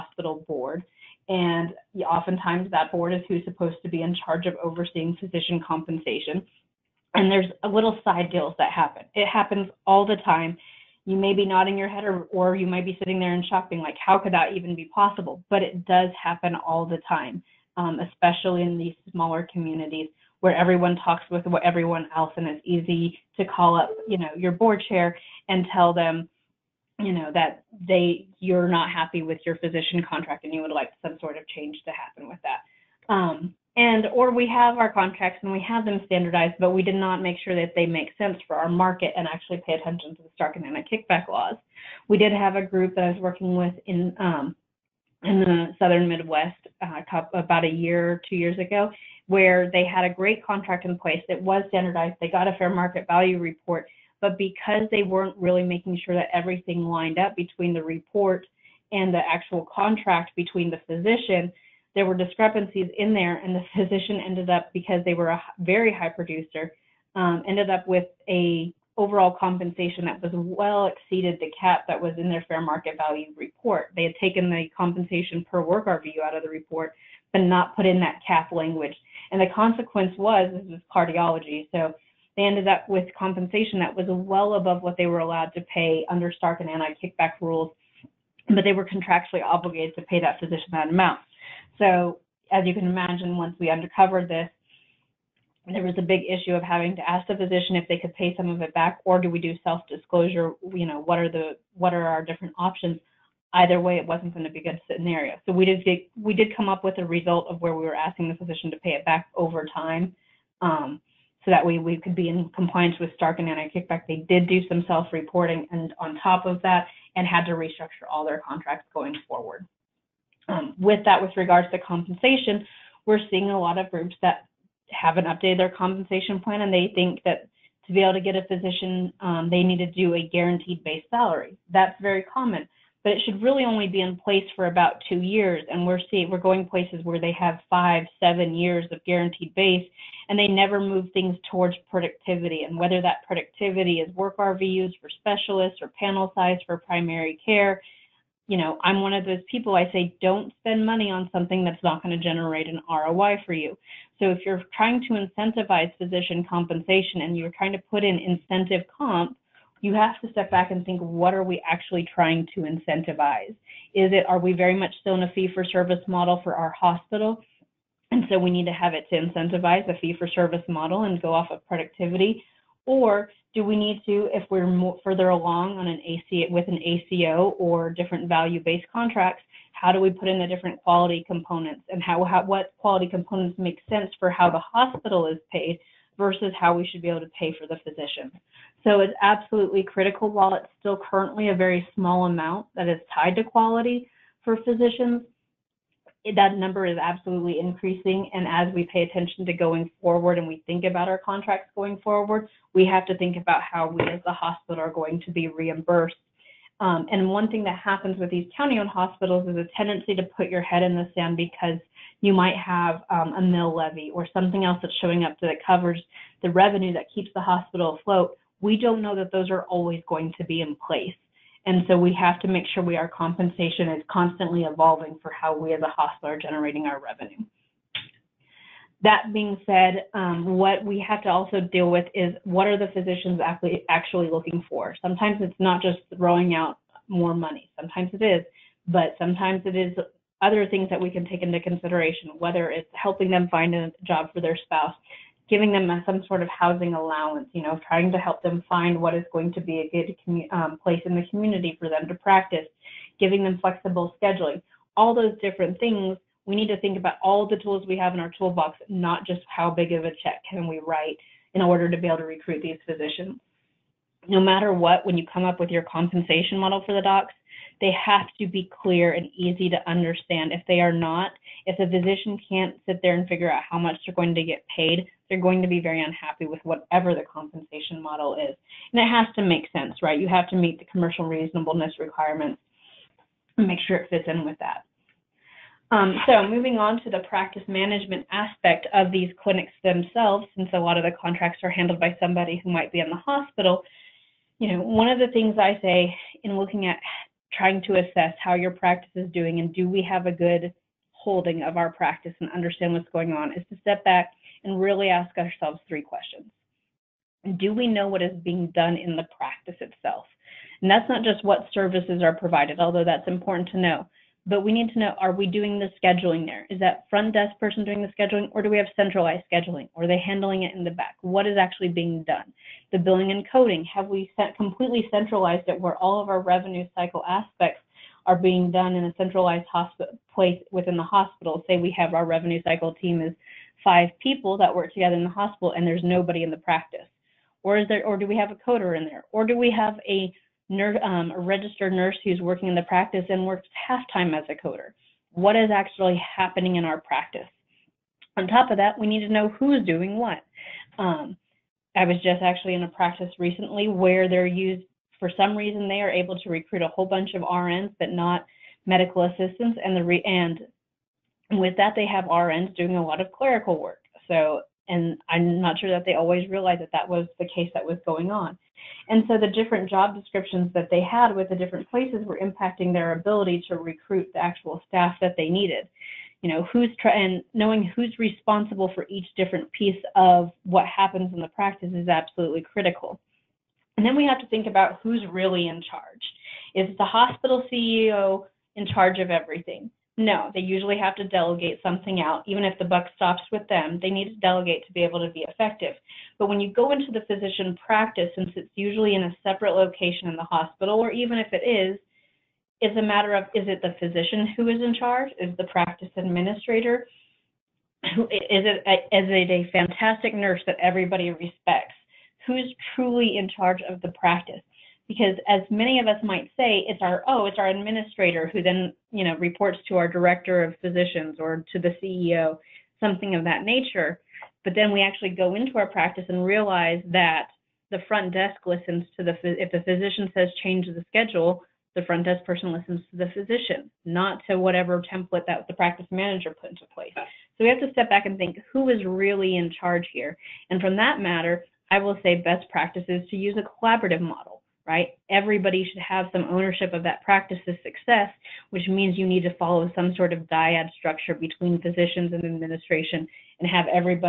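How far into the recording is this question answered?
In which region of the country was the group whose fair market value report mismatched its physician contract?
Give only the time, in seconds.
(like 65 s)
45 s.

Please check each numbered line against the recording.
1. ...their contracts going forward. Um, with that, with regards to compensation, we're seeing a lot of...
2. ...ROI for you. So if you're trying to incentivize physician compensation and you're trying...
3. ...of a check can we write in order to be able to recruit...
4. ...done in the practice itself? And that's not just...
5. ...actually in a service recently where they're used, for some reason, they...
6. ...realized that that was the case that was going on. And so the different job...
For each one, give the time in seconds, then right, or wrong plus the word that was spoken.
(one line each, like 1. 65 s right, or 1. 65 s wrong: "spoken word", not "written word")
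1. 118 s right
2. 152 s right
3. 259 s right
4. 308 s right
5. 352 s wrong: "practice", not "service"
6. 366 s right.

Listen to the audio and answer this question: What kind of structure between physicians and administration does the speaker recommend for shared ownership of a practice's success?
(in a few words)
Dyad structure.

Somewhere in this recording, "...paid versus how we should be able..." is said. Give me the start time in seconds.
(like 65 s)
185 s.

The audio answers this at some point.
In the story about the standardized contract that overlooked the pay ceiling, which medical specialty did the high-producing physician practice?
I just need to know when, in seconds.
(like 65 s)
80 s.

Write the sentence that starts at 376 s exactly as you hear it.
You know, who's tra- and knowing who's responsible for each different piece of what happens in the practice is absolutely critical.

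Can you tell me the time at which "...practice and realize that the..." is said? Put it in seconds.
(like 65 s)
425 s.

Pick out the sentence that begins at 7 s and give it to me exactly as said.
And there's a little side deals that happen.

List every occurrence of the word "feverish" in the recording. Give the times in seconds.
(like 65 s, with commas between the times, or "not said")
not said.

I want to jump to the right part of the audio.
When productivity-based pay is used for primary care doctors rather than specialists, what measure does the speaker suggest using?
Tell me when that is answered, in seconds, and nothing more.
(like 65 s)
145 s.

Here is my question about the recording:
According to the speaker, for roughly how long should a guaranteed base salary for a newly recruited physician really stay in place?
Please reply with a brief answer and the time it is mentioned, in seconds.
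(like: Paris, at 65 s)
2 years, at 134 s.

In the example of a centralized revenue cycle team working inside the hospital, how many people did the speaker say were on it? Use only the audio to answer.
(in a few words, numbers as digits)
5.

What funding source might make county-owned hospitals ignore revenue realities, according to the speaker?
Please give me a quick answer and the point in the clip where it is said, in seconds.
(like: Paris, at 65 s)
A mill levy, at 213 s.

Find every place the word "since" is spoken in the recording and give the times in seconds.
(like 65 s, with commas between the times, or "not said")
290 s, 398 s.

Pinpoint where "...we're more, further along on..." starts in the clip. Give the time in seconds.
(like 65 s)
174 s.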